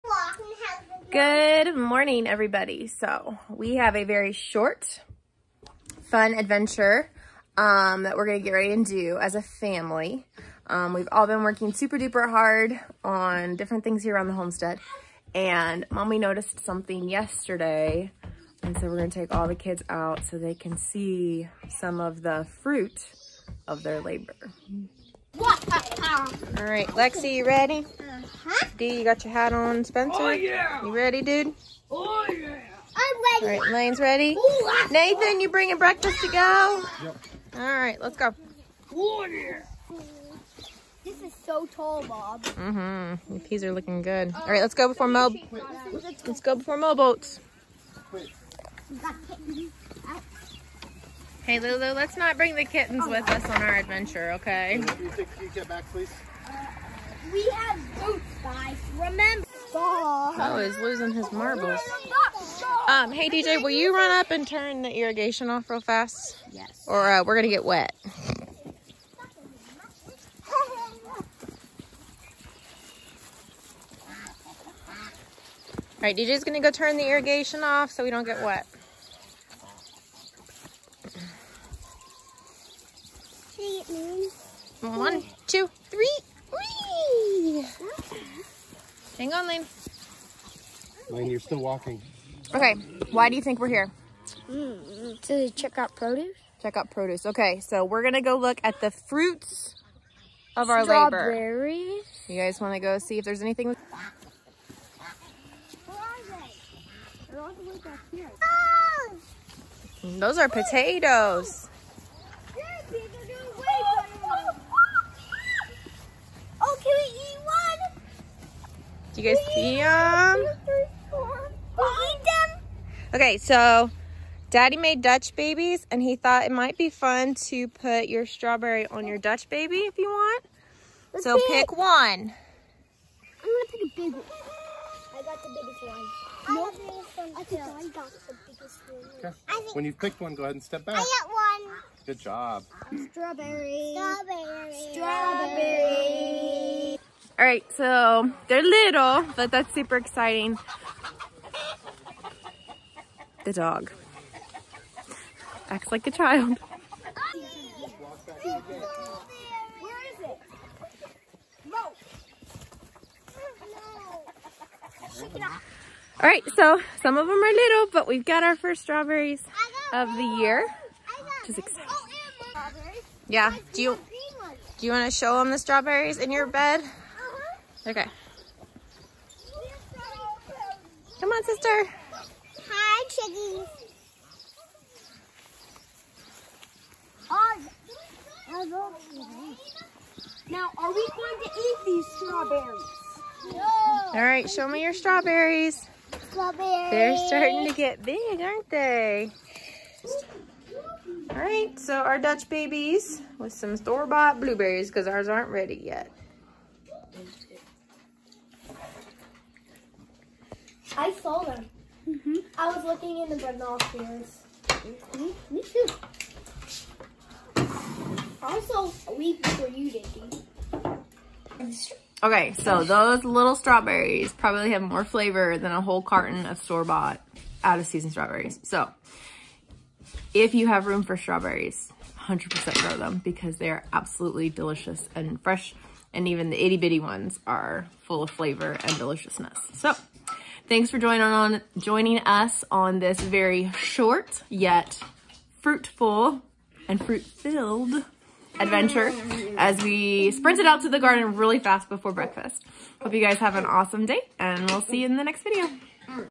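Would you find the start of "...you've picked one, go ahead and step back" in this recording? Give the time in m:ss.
2:19.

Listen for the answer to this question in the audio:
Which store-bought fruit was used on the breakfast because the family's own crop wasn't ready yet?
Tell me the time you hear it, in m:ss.
3:24.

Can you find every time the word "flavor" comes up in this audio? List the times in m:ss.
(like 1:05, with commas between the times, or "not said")
3:45, 3:58.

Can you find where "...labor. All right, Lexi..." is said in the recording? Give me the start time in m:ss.
0:23.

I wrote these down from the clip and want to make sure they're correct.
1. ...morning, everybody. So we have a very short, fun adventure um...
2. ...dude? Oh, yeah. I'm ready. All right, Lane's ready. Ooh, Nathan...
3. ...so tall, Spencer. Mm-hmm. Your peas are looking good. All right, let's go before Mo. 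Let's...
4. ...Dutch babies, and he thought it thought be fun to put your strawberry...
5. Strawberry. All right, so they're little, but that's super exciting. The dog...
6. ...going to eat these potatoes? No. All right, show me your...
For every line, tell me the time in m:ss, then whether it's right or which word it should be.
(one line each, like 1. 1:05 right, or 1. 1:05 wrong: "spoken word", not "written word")
1. 0:01 right
2. 0:31 right
3. 0:41 wrong: "Bob", not "Spencer"
4. 2:05 wrong: "might", not "thought"
5. 2:23 right
6. 3:11 wrong: "strawberries", not "potatoes".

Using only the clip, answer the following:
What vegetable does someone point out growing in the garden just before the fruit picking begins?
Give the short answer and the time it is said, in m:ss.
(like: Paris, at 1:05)
Potatoes, at 1:50.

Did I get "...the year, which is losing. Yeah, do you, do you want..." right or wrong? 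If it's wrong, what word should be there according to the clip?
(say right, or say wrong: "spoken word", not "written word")
wrong: "exciting", not "losing".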